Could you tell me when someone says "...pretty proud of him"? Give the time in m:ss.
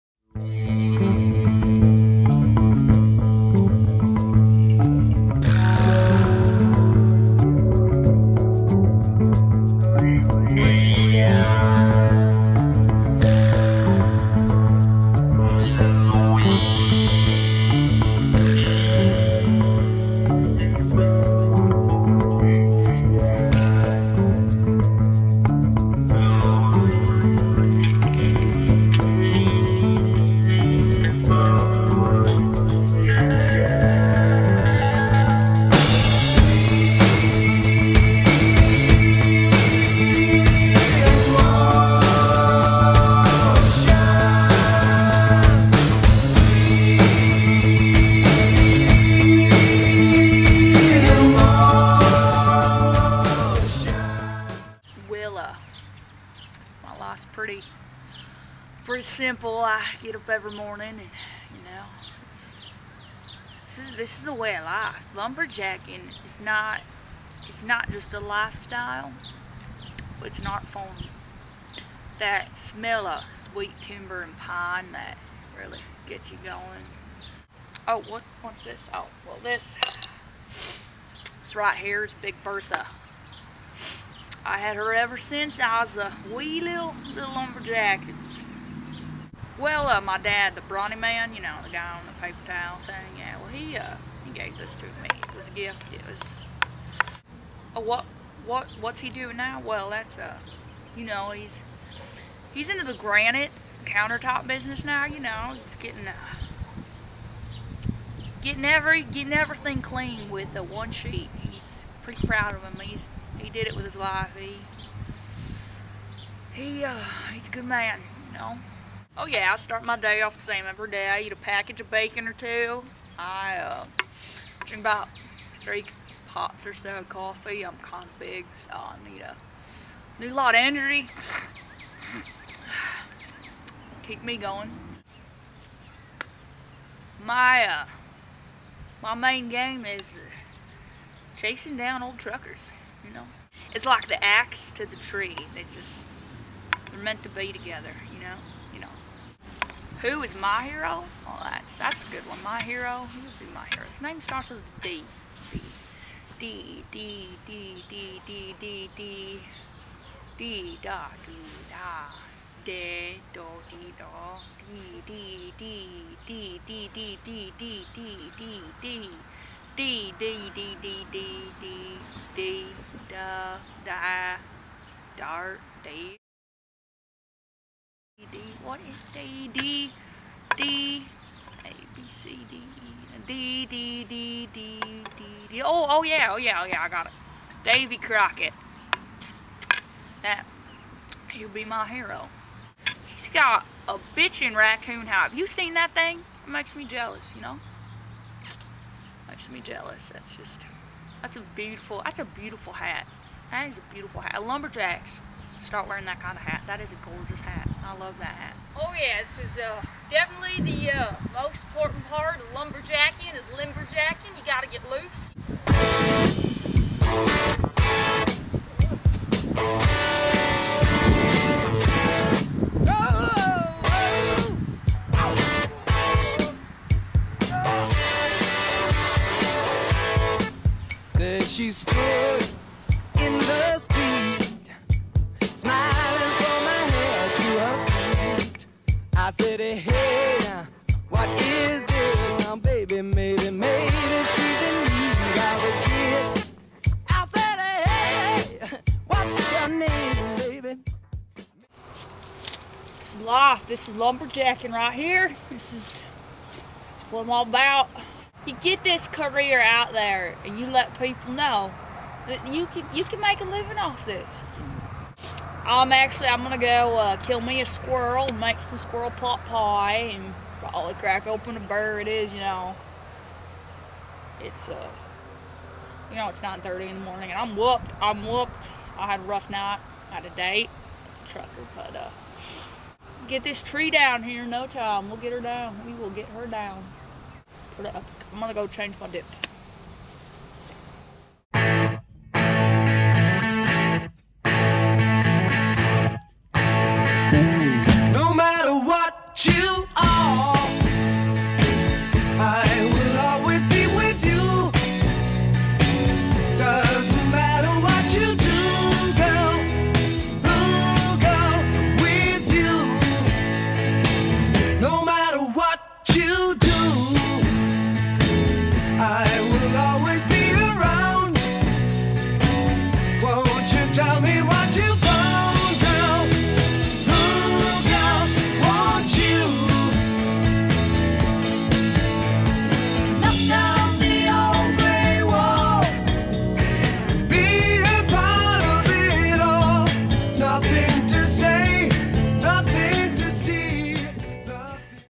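1:52.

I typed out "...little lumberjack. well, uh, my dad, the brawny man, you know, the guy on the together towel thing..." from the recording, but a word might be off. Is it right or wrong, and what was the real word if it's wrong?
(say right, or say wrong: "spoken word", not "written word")
wrong: "paper", not "together".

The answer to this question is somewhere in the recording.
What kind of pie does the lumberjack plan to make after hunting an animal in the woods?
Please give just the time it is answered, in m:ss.
4:28.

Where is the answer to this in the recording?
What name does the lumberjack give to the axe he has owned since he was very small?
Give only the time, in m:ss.
1:22.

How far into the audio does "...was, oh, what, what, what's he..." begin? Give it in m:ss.
1:36.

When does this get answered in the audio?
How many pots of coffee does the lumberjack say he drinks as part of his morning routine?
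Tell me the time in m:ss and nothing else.
2:05.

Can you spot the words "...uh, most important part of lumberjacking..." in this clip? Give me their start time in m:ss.
3:30.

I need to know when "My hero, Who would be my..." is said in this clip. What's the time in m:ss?
2:32.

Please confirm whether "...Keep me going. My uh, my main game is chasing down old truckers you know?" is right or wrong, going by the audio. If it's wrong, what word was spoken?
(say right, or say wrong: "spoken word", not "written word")
right.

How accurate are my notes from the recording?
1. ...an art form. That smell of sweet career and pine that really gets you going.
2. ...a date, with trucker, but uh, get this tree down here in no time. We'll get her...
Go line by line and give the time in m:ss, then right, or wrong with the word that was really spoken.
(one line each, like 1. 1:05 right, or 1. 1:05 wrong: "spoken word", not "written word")
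1. 1:10 wrong: "timber", not "career"
2. 4:40 right.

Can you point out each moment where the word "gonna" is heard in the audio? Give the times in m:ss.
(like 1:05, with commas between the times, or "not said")
4:26, 4:48.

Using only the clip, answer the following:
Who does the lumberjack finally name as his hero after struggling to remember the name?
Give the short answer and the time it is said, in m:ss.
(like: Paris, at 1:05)
Davy Crockett, at 3:07.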